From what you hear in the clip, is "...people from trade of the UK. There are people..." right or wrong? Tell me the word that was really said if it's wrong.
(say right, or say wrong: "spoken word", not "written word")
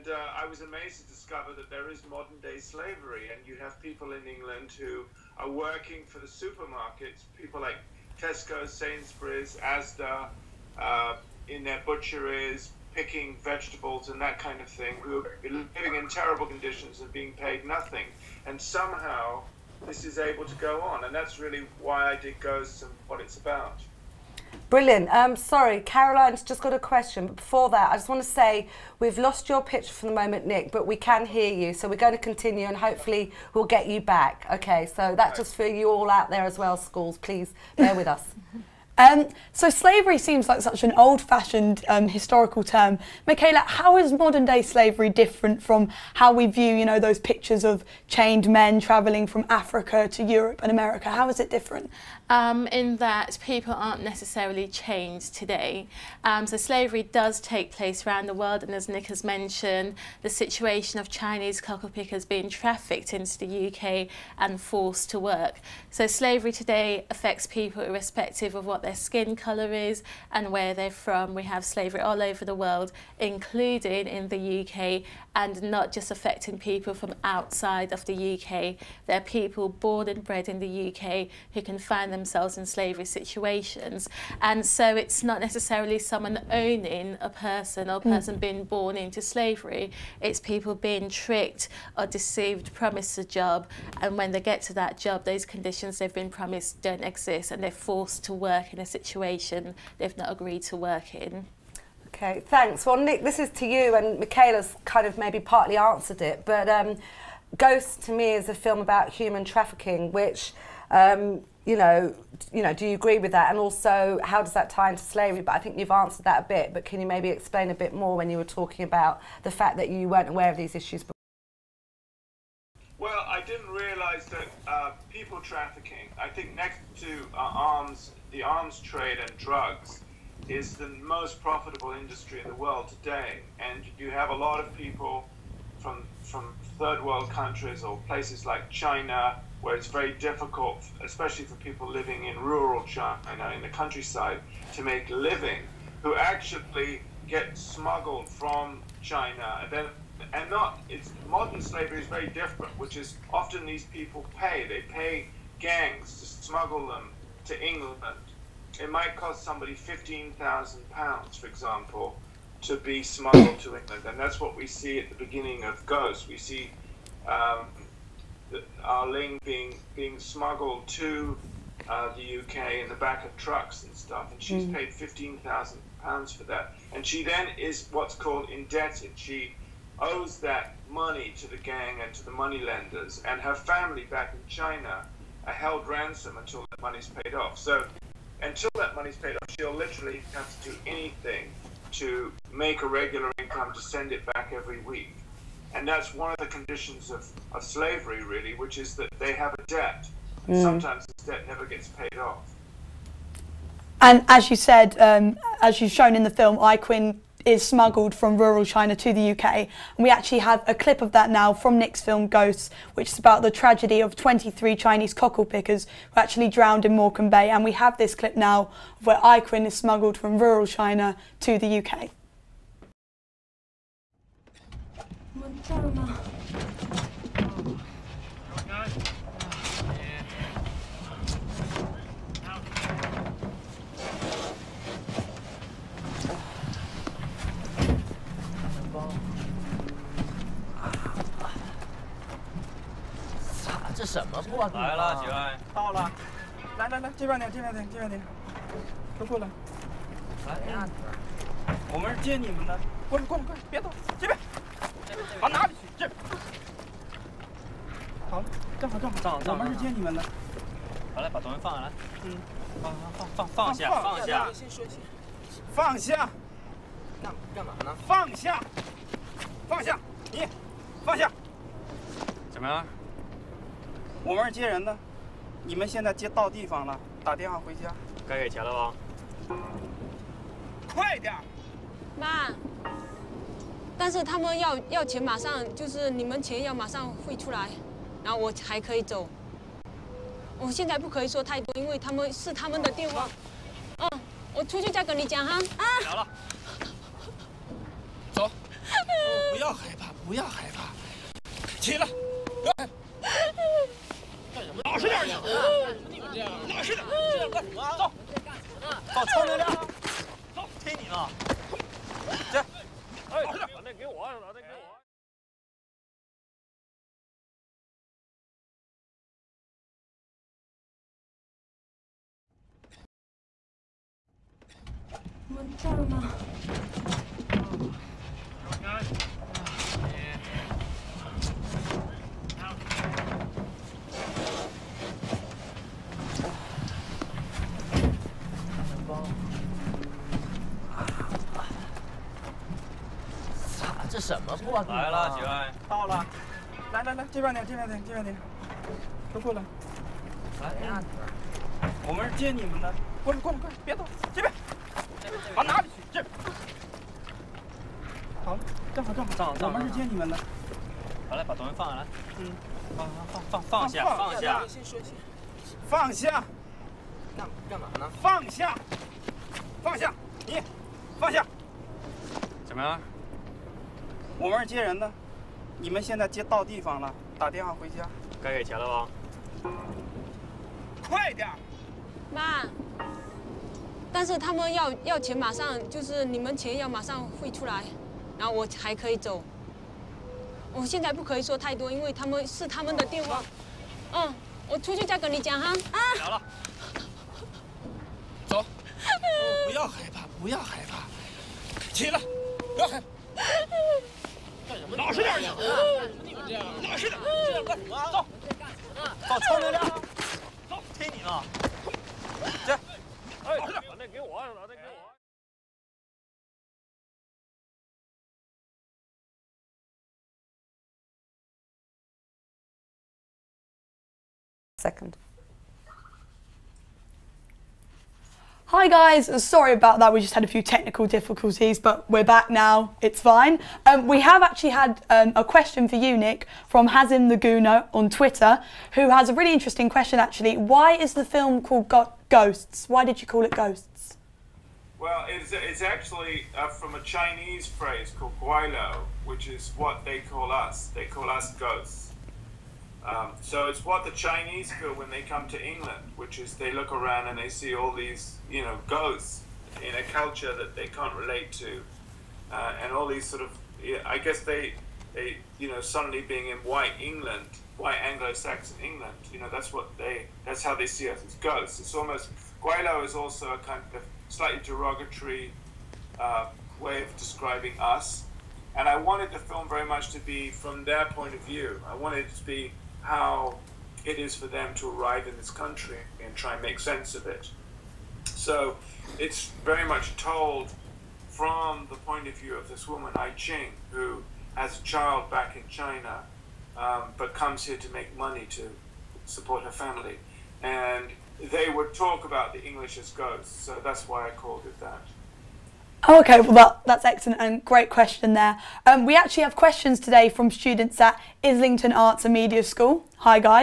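wrong: "outside", not "trade".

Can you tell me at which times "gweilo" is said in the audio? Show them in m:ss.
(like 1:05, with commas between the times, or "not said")
7:28, 7:52.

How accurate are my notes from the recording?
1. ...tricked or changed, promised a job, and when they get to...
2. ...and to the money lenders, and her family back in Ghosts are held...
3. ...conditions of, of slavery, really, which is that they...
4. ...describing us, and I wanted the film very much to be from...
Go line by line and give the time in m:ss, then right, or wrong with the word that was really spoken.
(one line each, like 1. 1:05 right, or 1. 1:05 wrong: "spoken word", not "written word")
1. 1:31 wrong: "deceived", not "changed"
2. 3:02 wrong: "China", not "Ghosts"
3. 3:16 right
4. 7:57 right.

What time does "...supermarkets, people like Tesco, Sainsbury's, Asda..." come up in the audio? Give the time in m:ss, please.
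0:06.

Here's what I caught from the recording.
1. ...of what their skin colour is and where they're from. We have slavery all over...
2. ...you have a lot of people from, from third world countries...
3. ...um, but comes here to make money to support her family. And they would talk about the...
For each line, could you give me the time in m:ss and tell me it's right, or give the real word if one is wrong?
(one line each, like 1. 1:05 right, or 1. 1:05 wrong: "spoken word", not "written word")
1. 1:08 right
2. 2:13 right
3. 8:16 right.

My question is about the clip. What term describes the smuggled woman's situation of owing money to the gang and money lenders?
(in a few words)
Indebted.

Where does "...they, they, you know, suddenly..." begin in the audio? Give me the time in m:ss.
7:44.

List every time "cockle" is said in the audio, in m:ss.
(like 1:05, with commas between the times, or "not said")
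1:01, 3:35.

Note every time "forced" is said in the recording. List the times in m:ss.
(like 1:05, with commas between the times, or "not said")
1:04, 1:37.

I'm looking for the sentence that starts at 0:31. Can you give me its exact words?
So we're going to continue and hopefully we'll get you back.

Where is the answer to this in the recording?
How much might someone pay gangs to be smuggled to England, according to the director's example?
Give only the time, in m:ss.
2:39.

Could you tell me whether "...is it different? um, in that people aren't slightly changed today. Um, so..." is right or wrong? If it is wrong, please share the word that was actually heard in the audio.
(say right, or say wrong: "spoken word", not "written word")
wrong: "necessarily", not "slightly".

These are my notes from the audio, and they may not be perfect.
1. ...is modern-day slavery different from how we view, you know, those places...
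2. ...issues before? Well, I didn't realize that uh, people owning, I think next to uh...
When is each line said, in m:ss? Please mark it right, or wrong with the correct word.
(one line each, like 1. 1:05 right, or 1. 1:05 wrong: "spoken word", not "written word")
1. 0:43 wrong: "pictures", not "places"
2. 2:00 wrong: "trafficking", not "owning".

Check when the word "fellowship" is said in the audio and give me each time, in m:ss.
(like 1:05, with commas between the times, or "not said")
not said.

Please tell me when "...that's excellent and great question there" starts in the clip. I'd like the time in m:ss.
8:26.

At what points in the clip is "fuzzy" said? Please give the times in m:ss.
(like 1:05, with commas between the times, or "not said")
not said.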